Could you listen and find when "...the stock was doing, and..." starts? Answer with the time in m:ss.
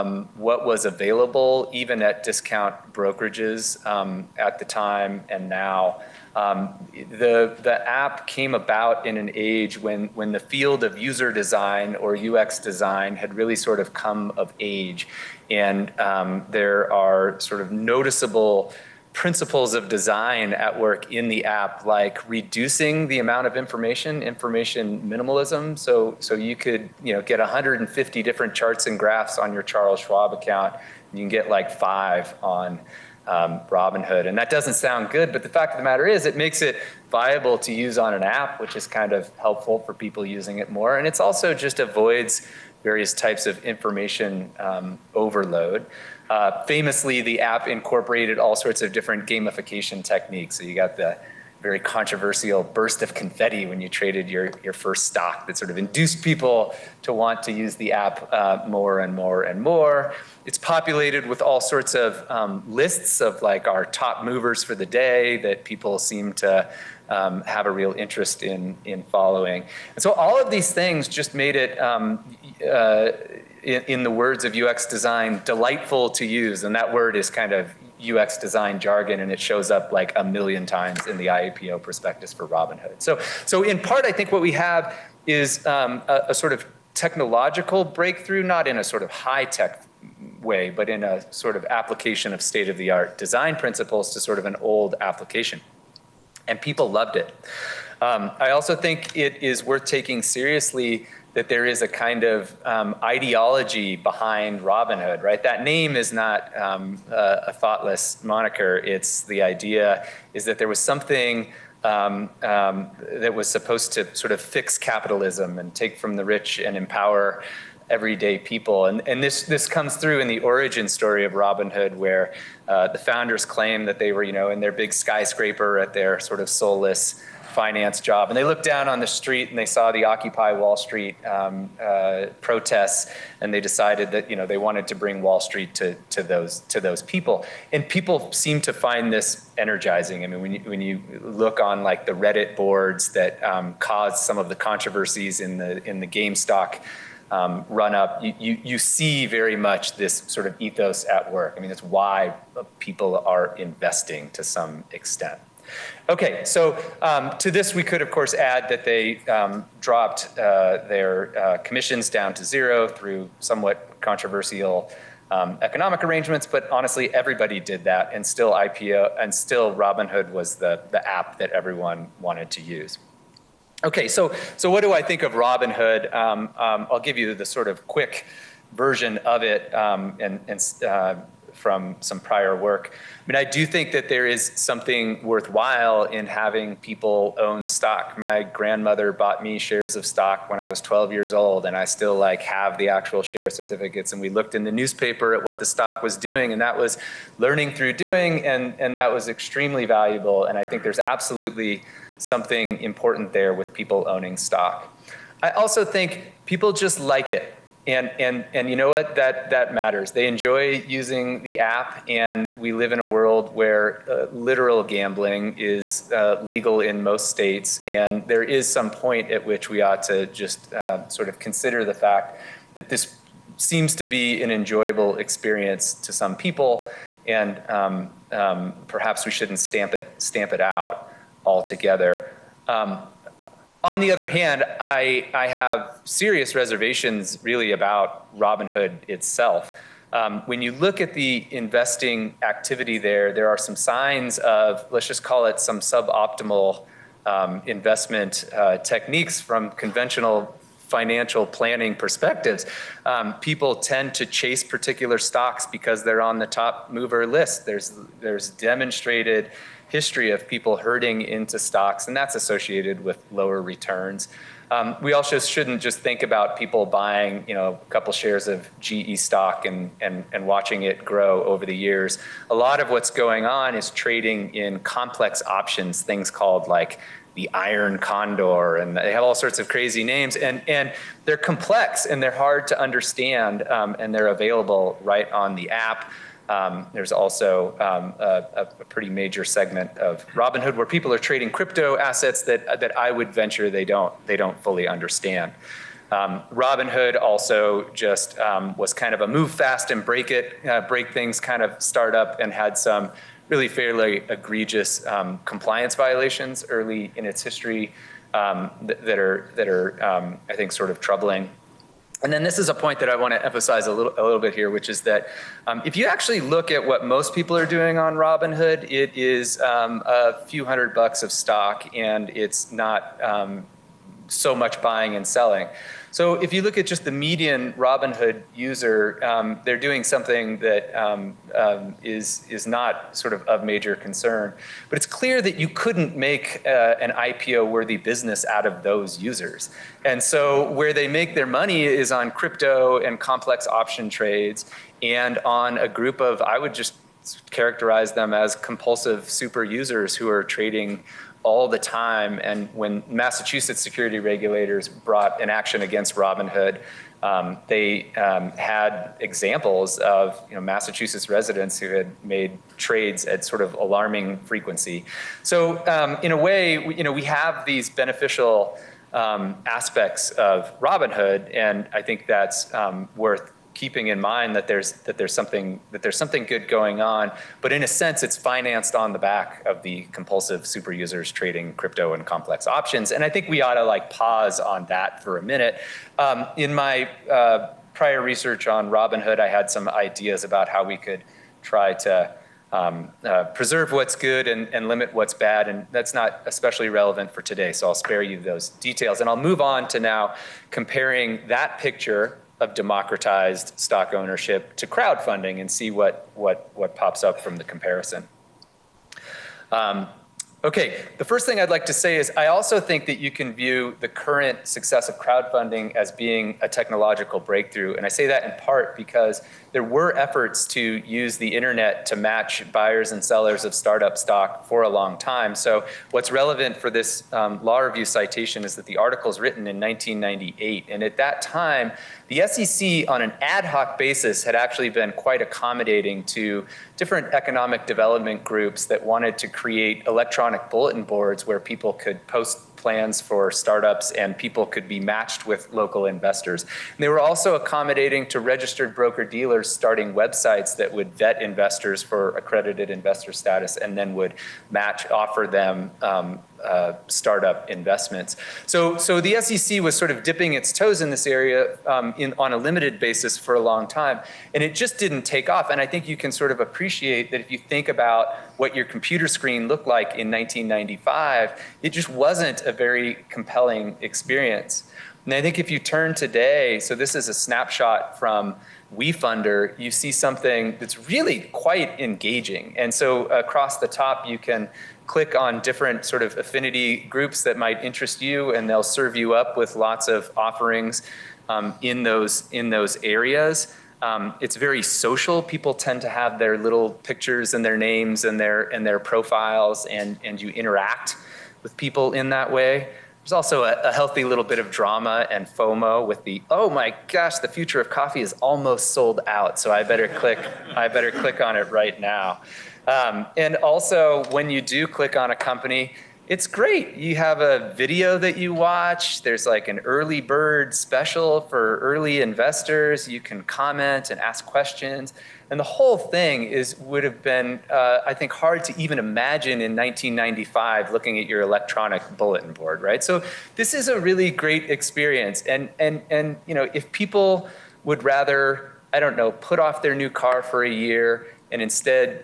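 3:15.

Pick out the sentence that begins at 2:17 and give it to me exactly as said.
And people seem to find this energizing.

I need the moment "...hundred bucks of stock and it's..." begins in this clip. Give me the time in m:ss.
5:20.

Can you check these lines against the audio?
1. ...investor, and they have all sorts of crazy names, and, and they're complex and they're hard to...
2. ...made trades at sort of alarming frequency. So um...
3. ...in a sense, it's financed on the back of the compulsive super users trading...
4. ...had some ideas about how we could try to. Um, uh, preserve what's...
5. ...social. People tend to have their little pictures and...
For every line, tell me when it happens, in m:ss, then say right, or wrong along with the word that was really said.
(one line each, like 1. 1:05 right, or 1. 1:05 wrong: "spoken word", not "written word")
1. 4:37 wrong: "condor", not "investor"
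2. 6:02 right
3. 6:17 right
4. 6:29 right
5. 8:14 right.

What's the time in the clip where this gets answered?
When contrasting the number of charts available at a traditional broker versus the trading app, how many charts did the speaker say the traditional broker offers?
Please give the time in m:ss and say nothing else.
0:27.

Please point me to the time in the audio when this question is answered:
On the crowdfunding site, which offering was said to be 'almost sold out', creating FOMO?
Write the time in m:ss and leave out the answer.
8:27.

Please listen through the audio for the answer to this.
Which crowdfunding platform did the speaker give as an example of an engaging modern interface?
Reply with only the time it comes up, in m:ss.
7:58.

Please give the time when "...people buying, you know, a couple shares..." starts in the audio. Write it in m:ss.
4:26.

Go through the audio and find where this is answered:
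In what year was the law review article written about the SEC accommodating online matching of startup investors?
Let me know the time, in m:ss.
7:09.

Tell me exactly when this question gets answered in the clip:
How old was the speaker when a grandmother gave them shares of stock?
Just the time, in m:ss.
3:10.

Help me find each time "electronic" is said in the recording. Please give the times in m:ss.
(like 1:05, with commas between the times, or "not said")
7:20, 8:51.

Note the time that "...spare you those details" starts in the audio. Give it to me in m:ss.
6:37.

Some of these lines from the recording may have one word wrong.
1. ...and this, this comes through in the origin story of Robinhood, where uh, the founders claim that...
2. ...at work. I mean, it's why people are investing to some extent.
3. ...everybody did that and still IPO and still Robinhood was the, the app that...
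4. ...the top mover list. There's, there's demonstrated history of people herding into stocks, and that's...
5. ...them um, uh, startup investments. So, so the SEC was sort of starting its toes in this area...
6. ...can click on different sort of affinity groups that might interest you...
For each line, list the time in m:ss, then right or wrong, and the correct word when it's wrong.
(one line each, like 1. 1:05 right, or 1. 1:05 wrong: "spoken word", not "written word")
1. 1:59 right
2. 2:31 right
3. 2:47 right
4. 4:16 right
5. 7:35 wrong: "dipping", not "starting"
6. 8:04 right.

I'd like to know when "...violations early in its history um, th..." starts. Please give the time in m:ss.
5:05.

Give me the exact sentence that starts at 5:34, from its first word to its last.
But it's clear that you couldn't make uh, an IPO-worthy business out of those users.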